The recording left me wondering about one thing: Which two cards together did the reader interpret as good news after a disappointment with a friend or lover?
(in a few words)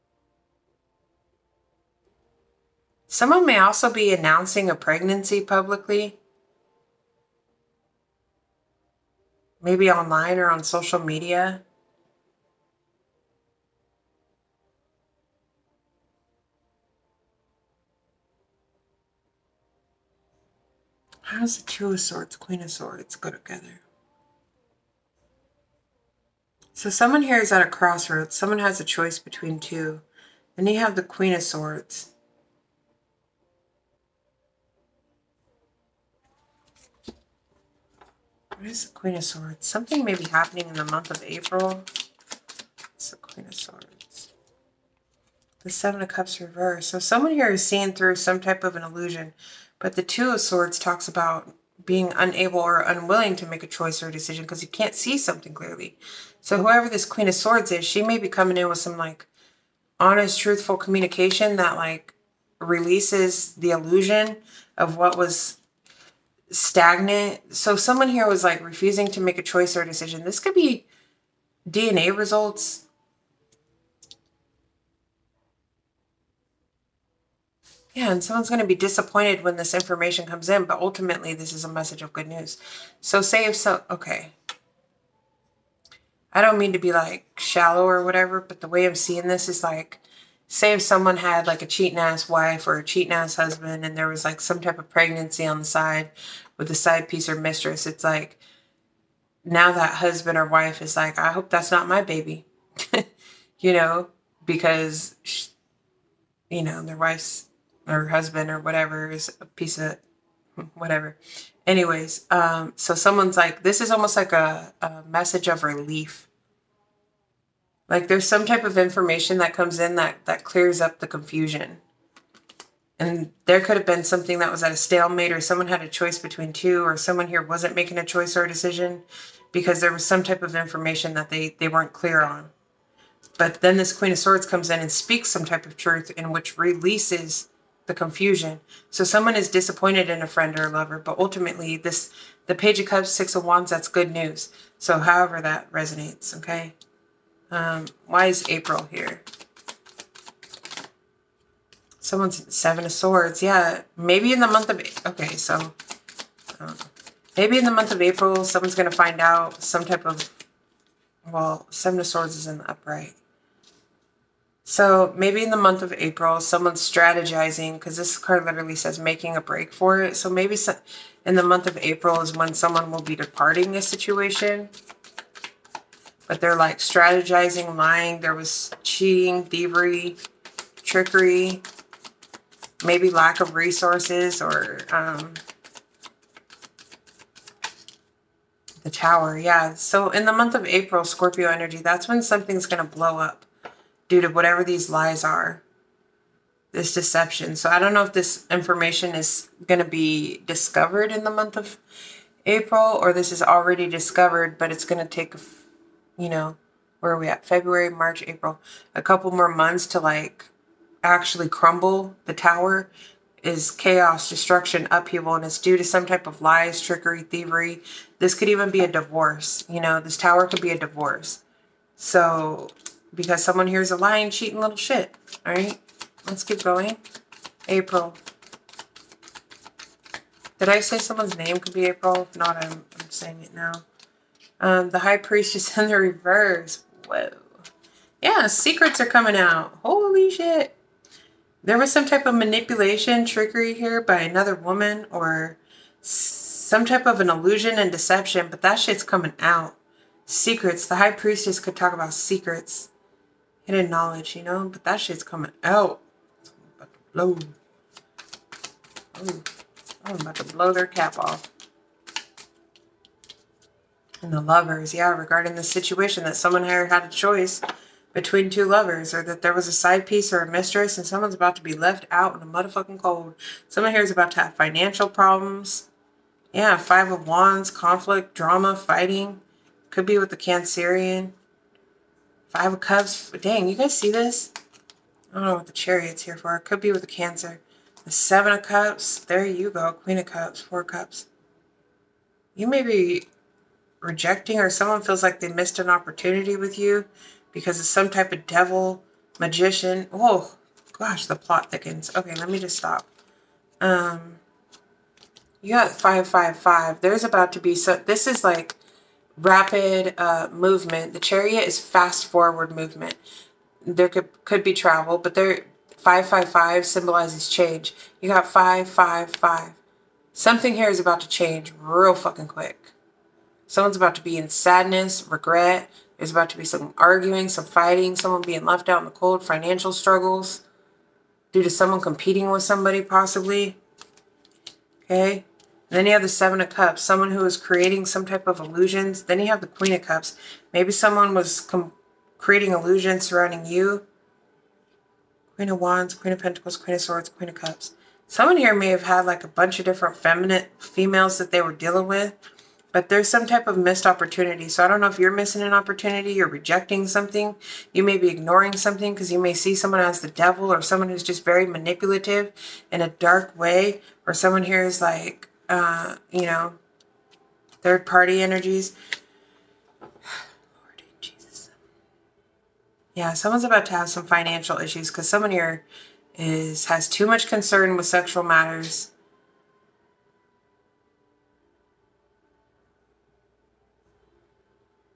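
Page of Cups, Six of Wands.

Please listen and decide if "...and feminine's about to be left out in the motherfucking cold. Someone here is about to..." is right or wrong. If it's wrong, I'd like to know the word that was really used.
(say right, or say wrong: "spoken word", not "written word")
wrong: "someone", not "feminine".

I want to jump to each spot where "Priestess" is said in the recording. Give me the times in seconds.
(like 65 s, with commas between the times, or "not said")
235 s, 251 s.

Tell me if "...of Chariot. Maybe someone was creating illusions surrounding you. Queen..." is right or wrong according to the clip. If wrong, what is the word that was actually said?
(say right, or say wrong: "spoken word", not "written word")
wrong: "Cups", not "Chariot".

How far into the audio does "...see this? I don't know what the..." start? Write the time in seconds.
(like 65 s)
283 s.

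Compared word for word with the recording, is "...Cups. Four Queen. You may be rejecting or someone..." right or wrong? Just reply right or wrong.
wrong.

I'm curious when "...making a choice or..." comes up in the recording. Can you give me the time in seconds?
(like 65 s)
127 s.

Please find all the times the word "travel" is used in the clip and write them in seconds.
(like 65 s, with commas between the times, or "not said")
314 s.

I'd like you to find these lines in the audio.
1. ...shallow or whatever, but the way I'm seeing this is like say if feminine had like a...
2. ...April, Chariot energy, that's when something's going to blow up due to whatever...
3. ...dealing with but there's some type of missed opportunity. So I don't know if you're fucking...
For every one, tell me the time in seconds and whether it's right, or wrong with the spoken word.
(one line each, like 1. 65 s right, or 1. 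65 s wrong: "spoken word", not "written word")
1. 87 s wrong: "someone", not "feminine"
2. 190 s wrong: "Scorpio", not "Chariot"
3. 351 s wrong: "missing", not "fucking".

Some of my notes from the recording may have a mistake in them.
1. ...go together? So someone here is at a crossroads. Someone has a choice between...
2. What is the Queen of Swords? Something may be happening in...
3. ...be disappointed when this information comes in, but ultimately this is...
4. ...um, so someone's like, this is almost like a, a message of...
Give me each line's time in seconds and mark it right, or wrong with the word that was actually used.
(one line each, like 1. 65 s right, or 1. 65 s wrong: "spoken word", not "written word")
1. 23 s right
2. 38 s right
3. 78 s right
4. 112 s right.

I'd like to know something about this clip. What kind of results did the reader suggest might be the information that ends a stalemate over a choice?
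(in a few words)
DNA results.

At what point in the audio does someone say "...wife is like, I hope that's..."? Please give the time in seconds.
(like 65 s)
100 s.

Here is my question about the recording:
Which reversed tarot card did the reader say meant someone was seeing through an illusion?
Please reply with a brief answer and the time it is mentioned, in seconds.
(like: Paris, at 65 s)
Seven of Cups reversed, at 45 s.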